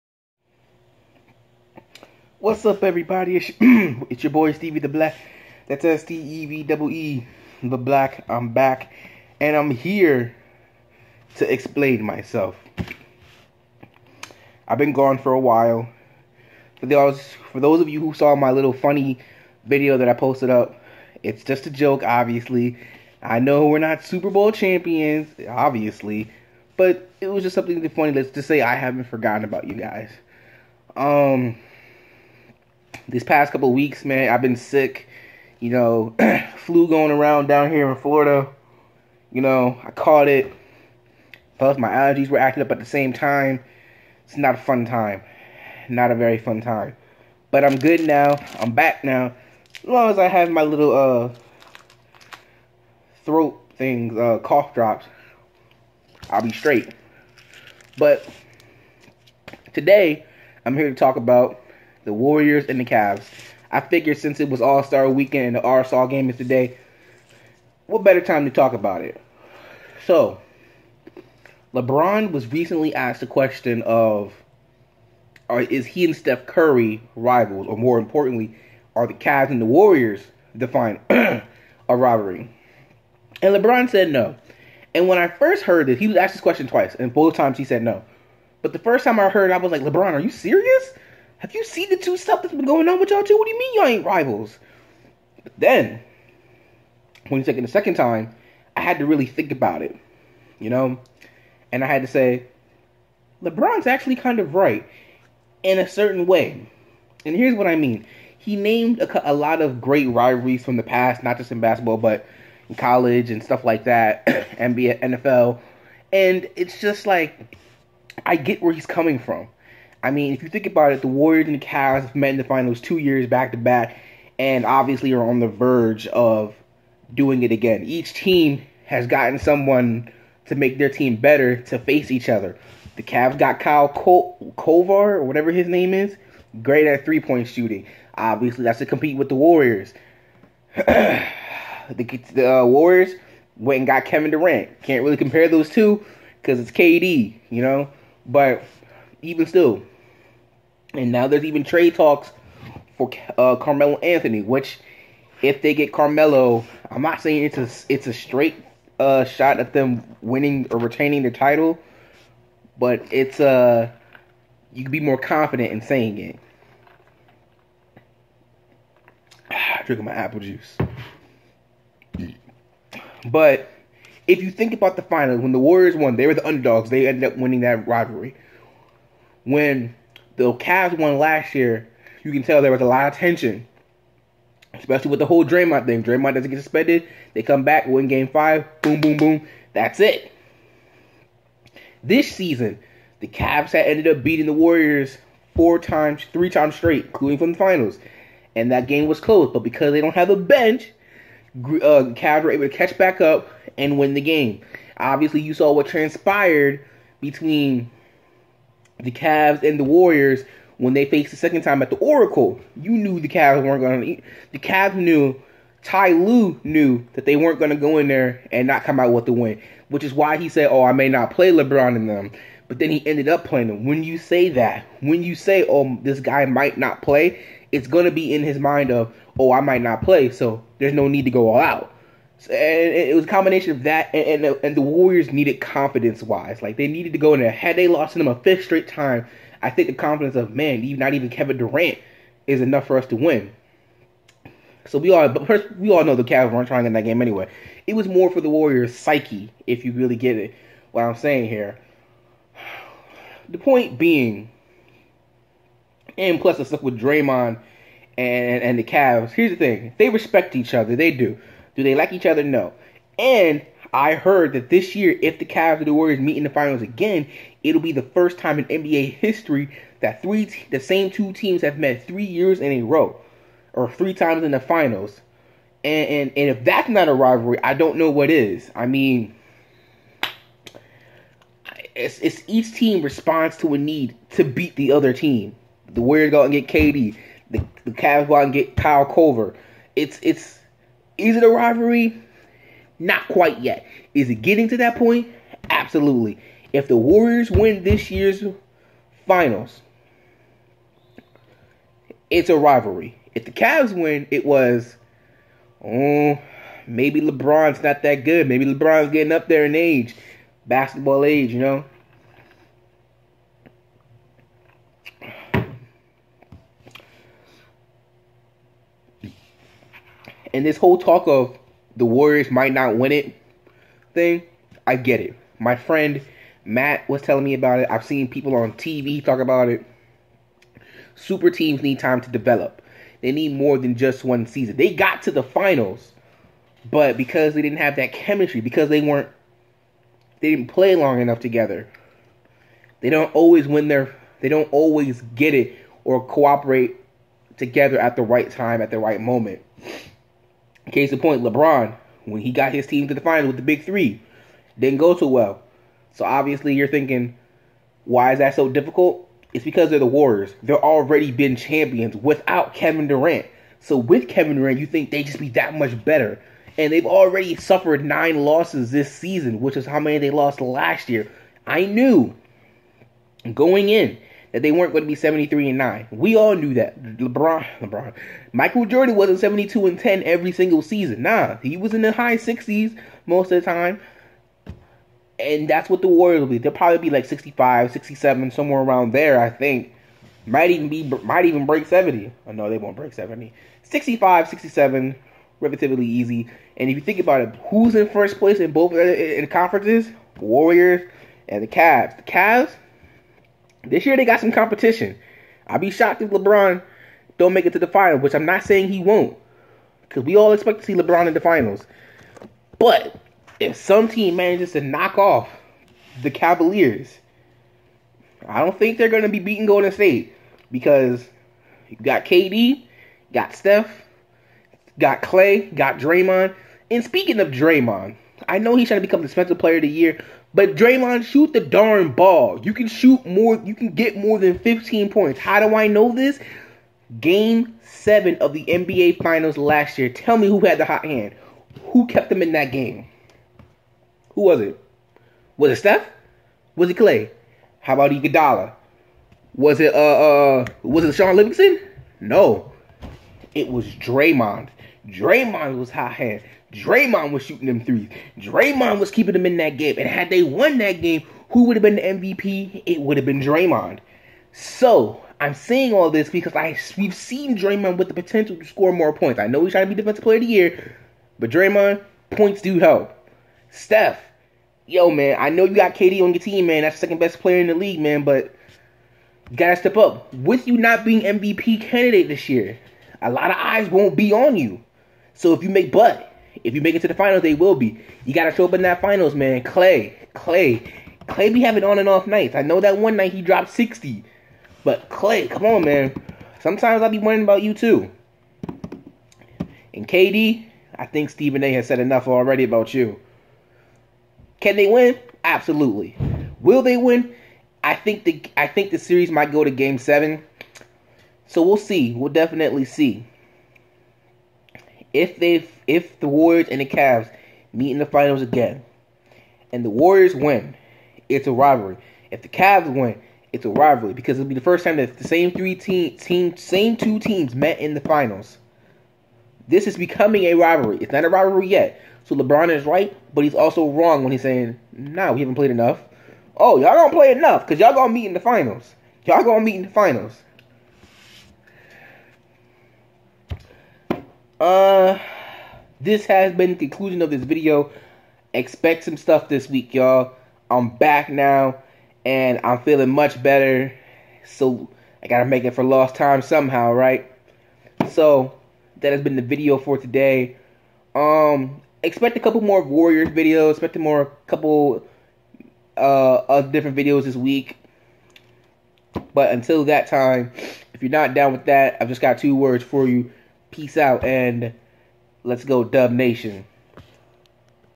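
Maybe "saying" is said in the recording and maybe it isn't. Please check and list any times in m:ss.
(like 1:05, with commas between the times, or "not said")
2:37, 2:45, 4:11, 6:48, 7:45, 8:54.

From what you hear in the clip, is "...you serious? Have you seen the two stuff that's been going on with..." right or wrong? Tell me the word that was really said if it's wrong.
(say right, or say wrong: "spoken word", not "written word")
right.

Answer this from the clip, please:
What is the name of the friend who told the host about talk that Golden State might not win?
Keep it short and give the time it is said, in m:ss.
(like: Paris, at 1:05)
Matt, at 5:26.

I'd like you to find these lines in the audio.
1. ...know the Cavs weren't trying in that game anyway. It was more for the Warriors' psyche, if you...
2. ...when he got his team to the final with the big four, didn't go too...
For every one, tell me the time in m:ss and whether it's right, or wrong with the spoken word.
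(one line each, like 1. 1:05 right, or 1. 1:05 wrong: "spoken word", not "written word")
1. 4:06 right
2. 5:52 wrong: "three", not "four".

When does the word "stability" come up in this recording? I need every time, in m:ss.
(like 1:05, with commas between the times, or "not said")
not said.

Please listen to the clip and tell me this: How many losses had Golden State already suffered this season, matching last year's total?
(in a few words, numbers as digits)
9.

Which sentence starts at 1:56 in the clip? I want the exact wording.
And it's just like, I get where he's coming from.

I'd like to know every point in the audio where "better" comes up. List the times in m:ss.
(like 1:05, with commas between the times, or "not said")
1:08, 2:11, 6:06, 9:13.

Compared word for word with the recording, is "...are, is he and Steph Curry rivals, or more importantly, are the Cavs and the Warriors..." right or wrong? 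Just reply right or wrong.
right.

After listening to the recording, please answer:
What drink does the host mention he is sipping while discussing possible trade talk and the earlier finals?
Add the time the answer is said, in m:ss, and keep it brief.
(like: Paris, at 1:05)
apple juice, at 2:50.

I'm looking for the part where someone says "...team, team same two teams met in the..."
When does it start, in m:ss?
8:45.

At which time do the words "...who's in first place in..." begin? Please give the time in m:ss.
6:37.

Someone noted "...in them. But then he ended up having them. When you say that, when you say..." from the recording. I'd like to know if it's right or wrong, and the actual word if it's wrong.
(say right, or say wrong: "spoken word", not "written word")
wrong: "playing", not "having".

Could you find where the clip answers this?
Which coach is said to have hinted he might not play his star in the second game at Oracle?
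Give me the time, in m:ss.
3:35.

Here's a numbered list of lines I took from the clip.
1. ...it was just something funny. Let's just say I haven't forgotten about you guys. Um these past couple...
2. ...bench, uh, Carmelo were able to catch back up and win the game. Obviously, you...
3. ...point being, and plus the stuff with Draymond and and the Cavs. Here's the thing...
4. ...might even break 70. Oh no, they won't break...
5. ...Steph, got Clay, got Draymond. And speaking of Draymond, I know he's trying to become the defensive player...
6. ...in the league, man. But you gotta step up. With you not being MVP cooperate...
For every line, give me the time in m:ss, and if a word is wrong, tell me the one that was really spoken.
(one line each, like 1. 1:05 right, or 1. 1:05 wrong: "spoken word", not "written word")
1. 0:27 right
2. 3:20 wrong: "Cavs", not "Carmelo"
3. 4:13 right
4. 6:31 right
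5. 7:03 right
6. 7:57 wrong: "candidate", not "cooperate".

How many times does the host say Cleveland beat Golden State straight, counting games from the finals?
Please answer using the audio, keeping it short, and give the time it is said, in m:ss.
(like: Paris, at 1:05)
3, at 3:16.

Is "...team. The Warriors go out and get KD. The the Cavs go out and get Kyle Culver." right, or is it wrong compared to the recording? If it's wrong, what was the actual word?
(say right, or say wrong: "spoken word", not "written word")
right.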